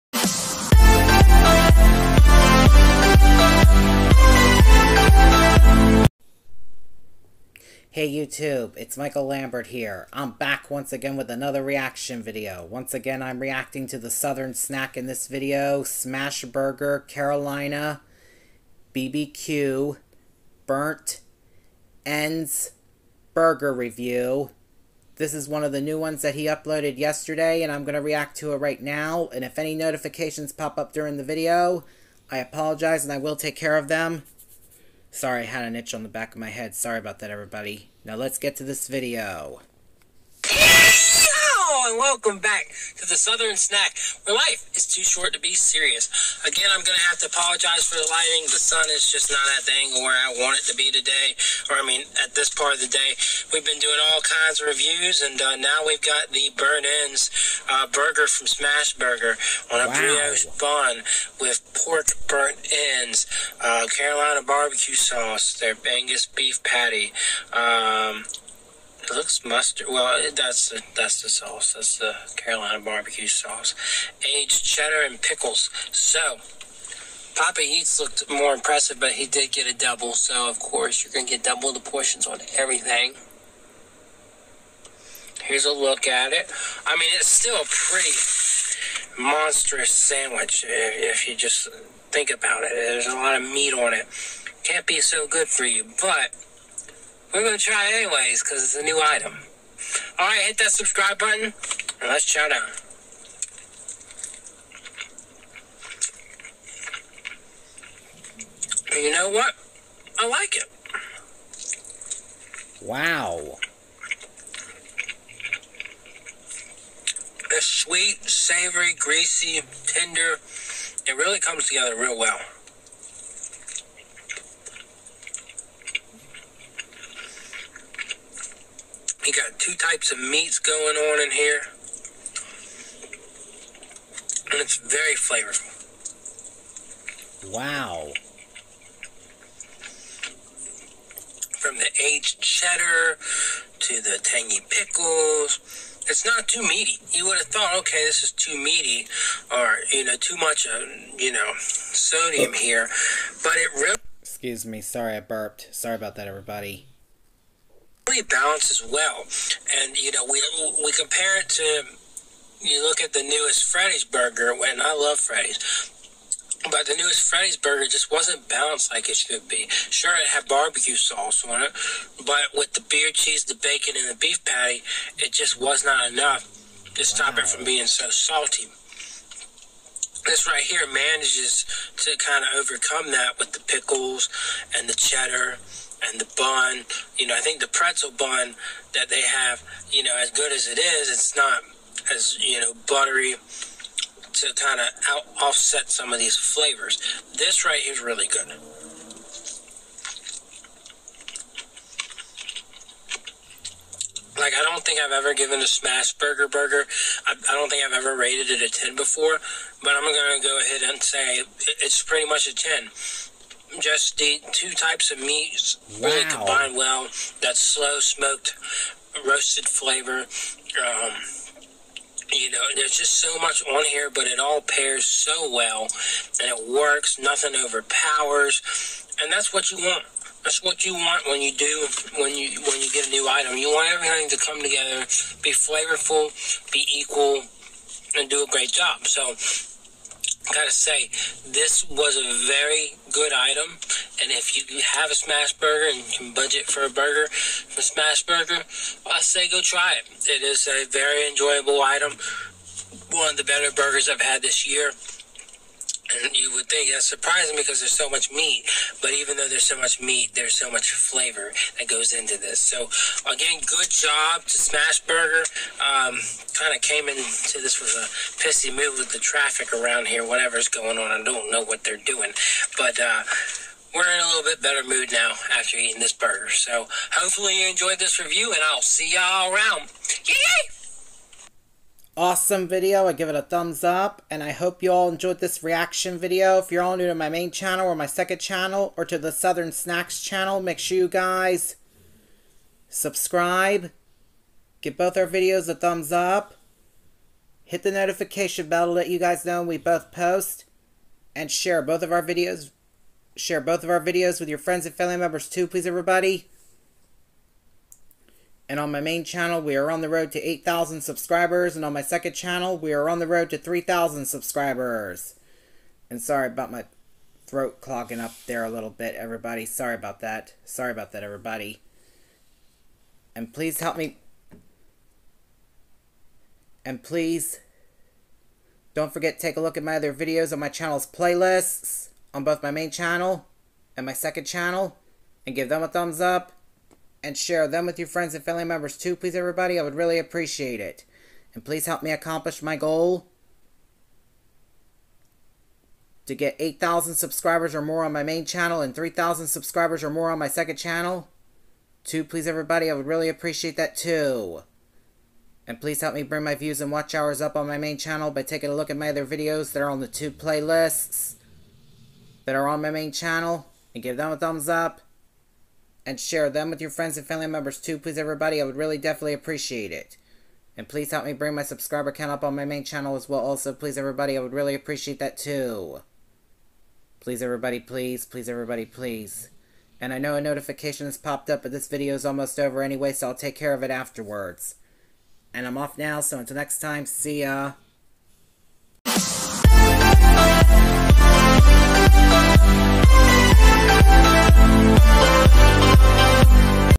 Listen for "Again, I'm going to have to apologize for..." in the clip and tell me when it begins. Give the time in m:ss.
0:46.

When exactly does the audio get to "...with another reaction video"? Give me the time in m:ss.
0:11.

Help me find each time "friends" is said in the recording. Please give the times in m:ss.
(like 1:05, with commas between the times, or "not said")
5:04, 5:38, 6:06.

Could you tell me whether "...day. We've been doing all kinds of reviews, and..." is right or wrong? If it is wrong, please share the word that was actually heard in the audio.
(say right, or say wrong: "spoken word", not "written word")
right.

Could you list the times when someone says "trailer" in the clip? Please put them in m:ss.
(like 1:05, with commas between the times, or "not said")
not said.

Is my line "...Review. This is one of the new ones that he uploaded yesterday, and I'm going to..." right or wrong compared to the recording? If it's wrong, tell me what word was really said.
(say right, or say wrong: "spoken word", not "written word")
right.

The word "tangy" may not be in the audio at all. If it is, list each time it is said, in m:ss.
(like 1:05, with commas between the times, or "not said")
2:24.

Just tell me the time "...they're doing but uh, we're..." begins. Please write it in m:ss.
4:31.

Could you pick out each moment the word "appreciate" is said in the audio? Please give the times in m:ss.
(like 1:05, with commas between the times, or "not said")
5:40, 5:53, 6:09, 6:14.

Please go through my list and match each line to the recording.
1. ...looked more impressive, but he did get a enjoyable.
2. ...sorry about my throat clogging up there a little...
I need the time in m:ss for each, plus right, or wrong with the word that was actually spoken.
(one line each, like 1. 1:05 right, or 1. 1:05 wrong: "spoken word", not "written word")
1. 1:17 wrong: "double", not "enjoyable"
2. 5:16 right.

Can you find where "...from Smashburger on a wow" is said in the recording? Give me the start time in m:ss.
0:58.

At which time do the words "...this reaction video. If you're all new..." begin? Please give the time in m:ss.
4:45.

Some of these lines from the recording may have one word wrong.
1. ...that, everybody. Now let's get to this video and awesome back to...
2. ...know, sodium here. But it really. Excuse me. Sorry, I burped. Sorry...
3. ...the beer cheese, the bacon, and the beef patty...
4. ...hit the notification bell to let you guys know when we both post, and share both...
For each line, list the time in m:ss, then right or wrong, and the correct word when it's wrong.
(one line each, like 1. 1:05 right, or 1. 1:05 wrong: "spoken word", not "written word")
1. 0:37 wrong: "welcome", not "awesome"
2. 2:31 right
3. 2:52 right
4. 4:57 right.